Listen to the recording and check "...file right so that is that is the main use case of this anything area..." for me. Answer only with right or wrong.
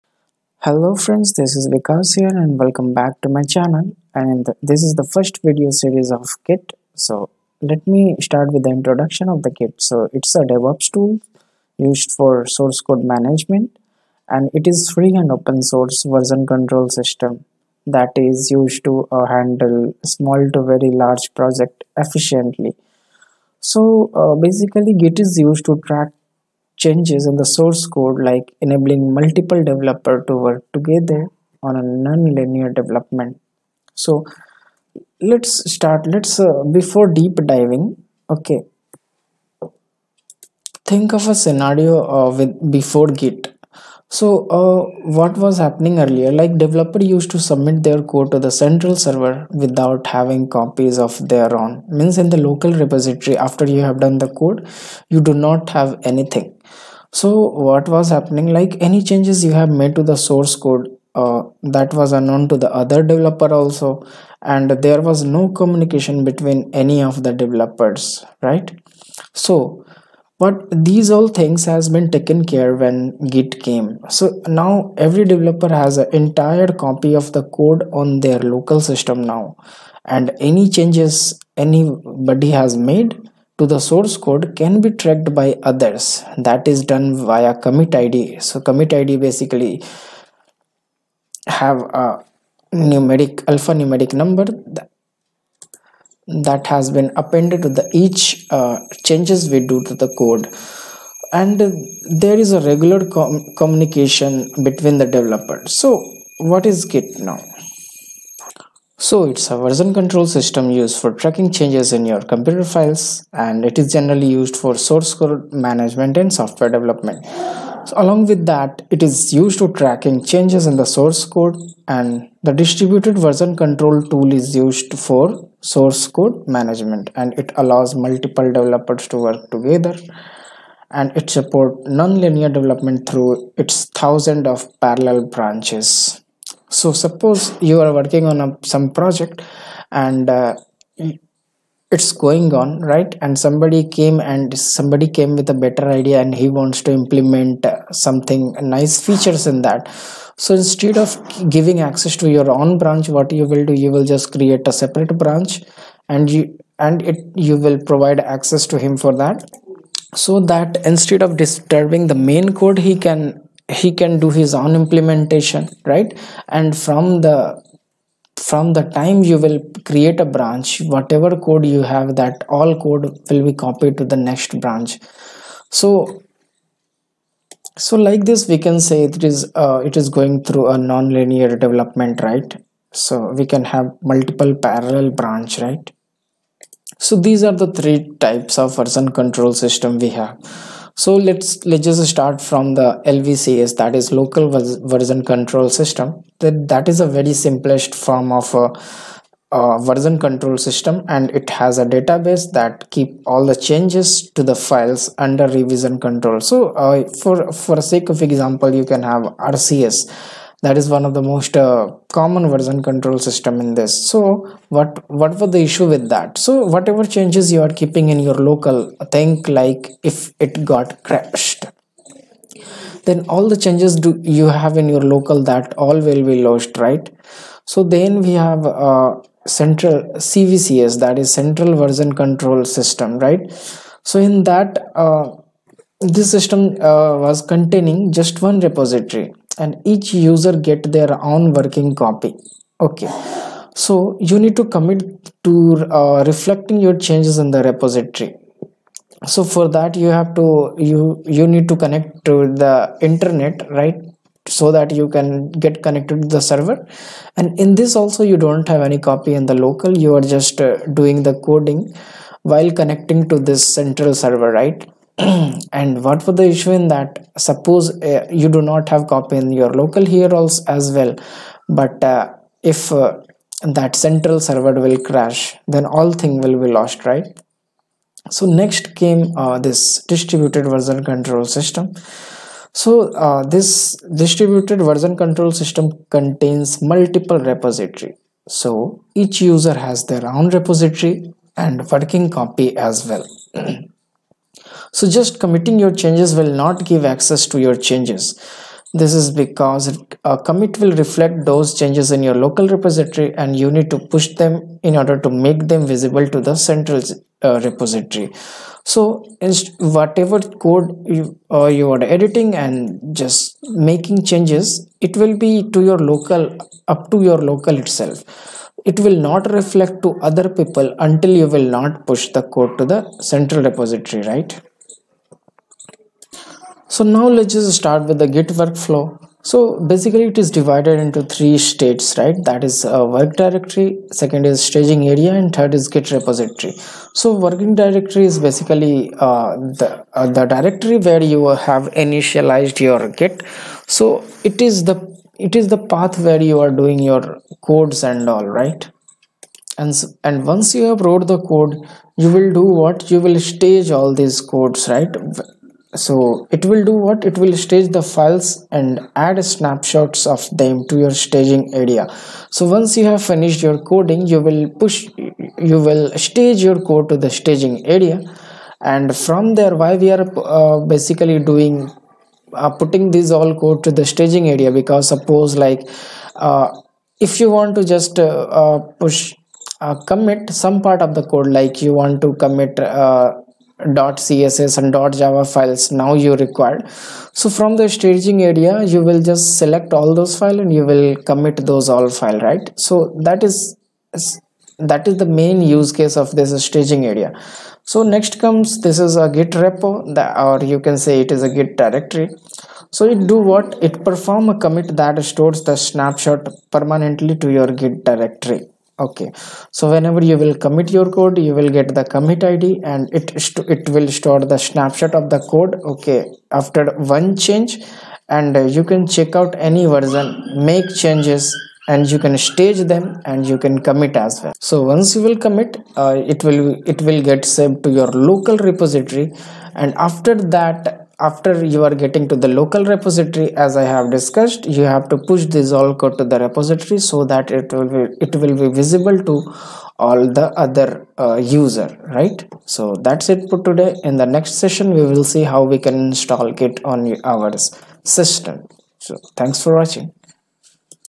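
wrong.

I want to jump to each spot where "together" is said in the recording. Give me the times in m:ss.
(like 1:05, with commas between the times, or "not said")
0:30, 2:09.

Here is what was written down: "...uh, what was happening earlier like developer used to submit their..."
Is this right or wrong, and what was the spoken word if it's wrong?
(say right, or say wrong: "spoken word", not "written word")
right.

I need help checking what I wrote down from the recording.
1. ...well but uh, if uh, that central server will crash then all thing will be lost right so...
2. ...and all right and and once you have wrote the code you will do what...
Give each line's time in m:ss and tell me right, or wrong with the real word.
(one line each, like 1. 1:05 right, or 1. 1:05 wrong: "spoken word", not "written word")
1. 4:30 right
2. 5:48 right.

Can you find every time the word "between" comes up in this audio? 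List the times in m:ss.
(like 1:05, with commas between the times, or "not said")
1:06, 1:44.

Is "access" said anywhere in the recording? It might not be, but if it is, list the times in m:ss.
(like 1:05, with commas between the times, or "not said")
2:31, 2:38, 4:57.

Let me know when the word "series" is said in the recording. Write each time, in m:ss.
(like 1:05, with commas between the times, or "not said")
0:05.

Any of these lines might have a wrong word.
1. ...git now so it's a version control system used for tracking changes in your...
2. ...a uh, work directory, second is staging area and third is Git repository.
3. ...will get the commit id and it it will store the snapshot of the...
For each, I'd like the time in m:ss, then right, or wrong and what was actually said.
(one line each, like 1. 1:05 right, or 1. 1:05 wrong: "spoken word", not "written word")
1. 1:46 right
2. 5:32 right
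3. 6:51 right.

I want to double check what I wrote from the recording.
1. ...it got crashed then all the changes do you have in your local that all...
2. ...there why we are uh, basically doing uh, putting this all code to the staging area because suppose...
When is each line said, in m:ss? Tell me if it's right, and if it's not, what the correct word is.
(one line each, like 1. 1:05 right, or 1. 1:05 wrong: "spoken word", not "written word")
1. 3:40 right
2. 6:09 right.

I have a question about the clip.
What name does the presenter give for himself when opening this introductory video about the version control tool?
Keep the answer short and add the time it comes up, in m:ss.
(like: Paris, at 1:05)
Vikas, at 0:01.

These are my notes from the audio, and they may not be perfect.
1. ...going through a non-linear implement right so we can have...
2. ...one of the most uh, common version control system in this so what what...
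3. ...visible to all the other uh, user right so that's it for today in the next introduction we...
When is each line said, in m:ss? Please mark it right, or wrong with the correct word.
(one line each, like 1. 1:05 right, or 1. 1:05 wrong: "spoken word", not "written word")
1. 3:00 wrong: "development", not "implement"
2. 3:30 right
3. 7:18 wrong: "session", not "introduction".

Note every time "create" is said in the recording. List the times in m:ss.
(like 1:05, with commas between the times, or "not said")
2:34, 2:49.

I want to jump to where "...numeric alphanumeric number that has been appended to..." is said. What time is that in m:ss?
1:32.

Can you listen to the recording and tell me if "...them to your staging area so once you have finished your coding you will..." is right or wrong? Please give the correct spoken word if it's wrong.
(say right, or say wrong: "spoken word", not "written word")
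right.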